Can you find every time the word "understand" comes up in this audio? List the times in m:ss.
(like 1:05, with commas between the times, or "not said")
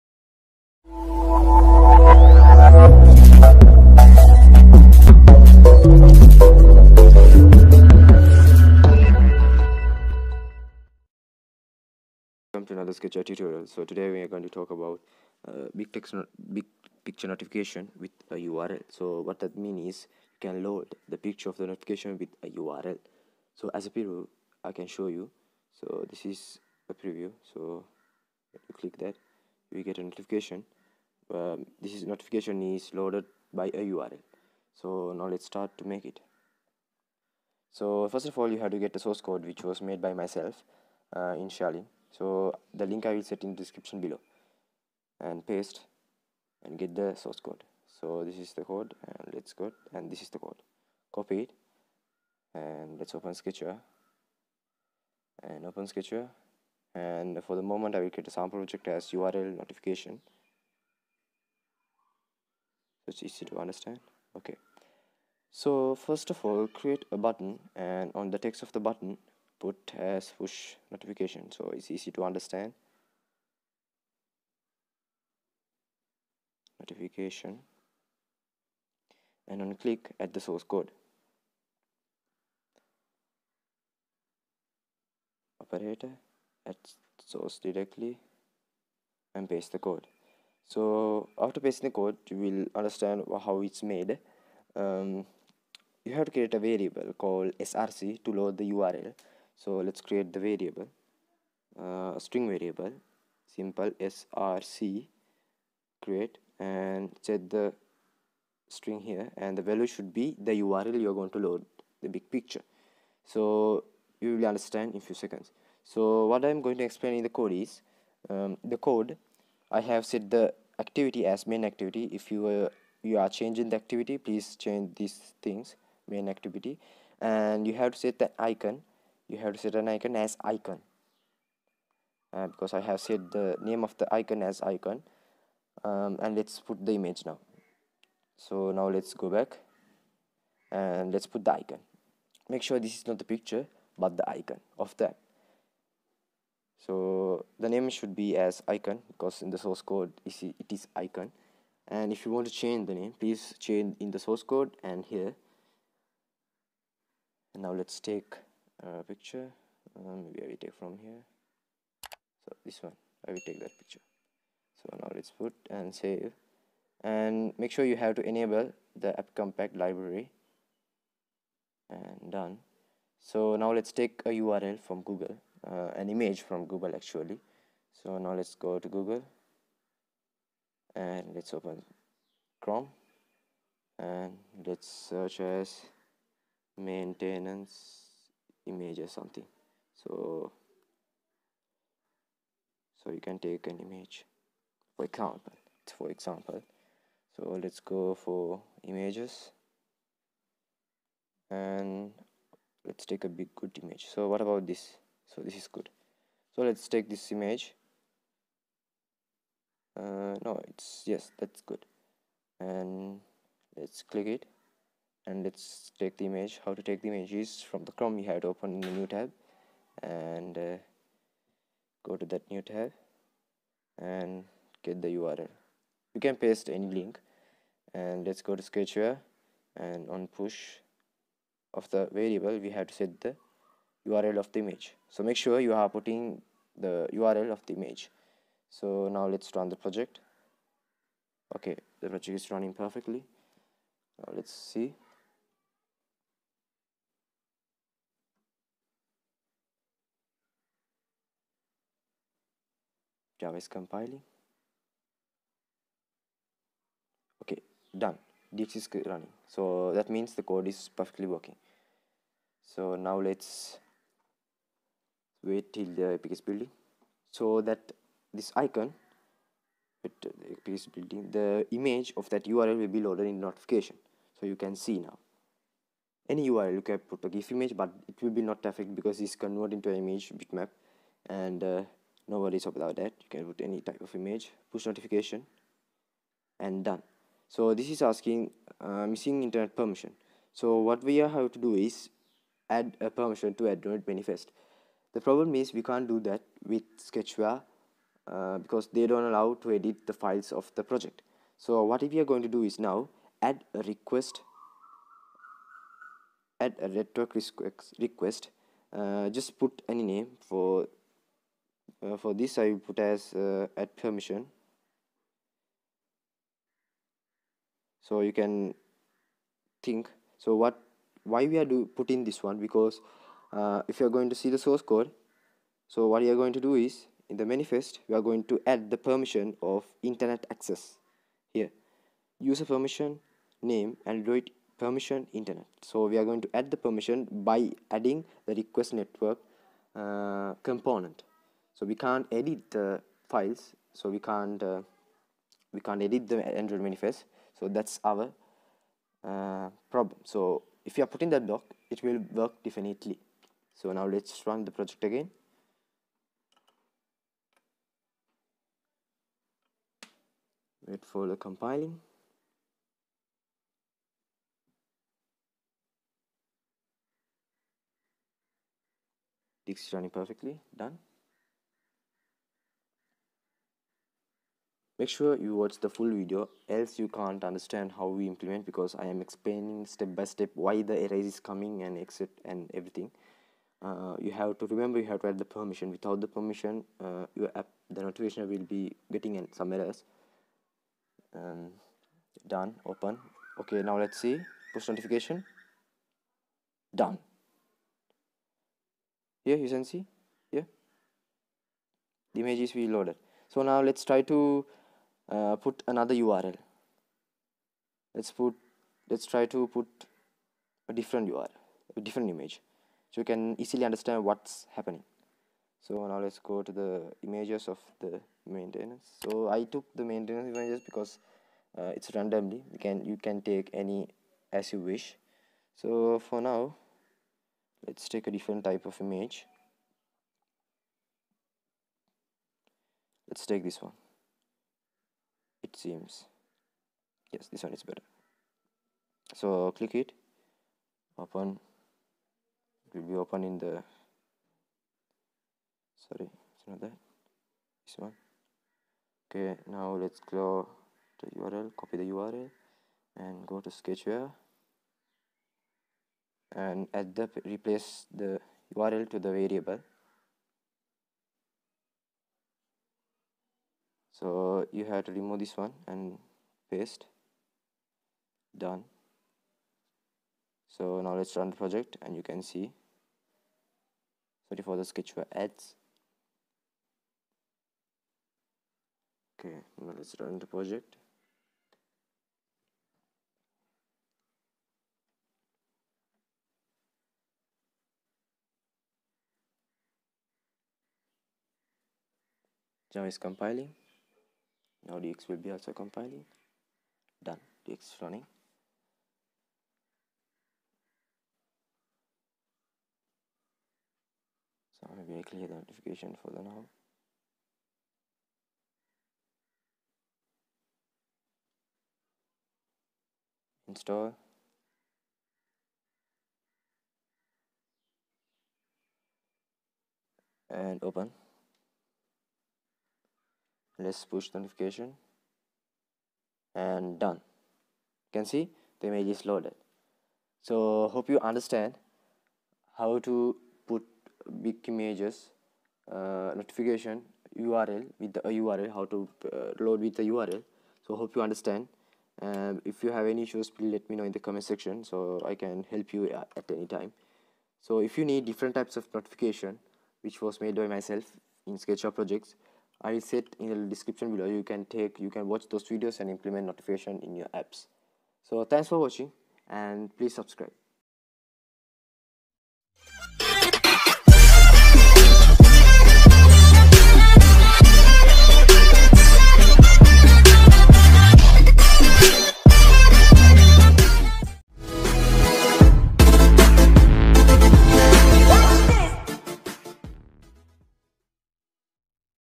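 1:03, 1:12, 1:32, 1:54, 6:17, 6:53, 8:51, 9:01.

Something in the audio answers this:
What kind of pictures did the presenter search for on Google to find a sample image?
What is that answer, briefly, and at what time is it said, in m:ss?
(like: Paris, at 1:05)
maintenance image, at 3:06.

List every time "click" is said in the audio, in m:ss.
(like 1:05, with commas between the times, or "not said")
0:28, 1:19, 3:34, 7:19.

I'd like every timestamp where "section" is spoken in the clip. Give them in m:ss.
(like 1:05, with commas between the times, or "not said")
9:04.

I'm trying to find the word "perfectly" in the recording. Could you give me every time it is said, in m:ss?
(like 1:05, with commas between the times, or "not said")
4:02, 4:20, 6:10.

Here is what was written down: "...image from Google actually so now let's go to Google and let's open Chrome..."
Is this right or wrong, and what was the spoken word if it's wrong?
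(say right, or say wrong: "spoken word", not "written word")
right.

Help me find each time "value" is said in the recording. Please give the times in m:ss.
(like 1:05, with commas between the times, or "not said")
1:49.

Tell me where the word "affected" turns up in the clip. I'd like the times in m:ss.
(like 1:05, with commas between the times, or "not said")
4:38.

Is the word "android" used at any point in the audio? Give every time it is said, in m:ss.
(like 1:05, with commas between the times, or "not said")
4:53, 5:34, 5:46.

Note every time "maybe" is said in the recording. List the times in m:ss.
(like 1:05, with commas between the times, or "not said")
2:40, 8:24.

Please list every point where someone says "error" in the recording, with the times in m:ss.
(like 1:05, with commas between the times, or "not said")
6:20, 6:29.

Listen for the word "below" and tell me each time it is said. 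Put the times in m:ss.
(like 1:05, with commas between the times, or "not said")
0:44, 9:14.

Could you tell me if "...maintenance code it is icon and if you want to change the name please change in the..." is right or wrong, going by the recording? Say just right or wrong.
wrong.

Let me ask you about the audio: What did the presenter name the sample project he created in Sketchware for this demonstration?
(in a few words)
URL notification.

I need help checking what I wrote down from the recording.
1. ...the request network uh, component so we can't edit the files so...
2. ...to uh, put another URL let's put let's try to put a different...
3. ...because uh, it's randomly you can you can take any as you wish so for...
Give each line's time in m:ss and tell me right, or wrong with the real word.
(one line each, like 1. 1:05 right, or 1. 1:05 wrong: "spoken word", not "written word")
1. 5:38 right
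2. 6:44 right
3. 7:00 right.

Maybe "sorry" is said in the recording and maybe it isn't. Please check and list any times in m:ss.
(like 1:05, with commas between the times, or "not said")
7:26, 7:54.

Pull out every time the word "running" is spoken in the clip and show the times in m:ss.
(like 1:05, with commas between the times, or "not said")
4:02, 4:19, 6:09, 8:18.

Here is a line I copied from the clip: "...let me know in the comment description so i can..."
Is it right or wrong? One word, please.
wrong.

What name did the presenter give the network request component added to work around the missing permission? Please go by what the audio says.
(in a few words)
add permission.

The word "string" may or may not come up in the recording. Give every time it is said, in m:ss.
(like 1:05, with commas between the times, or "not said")
1:42, 1:48.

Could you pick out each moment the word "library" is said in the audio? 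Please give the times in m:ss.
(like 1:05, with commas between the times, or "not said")
2:49.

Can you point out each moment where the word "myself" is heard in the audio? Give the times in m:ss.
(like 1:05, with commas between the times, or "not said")
0:40, 9:10.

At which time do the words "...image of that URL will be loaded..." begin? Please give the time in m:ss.
4:31.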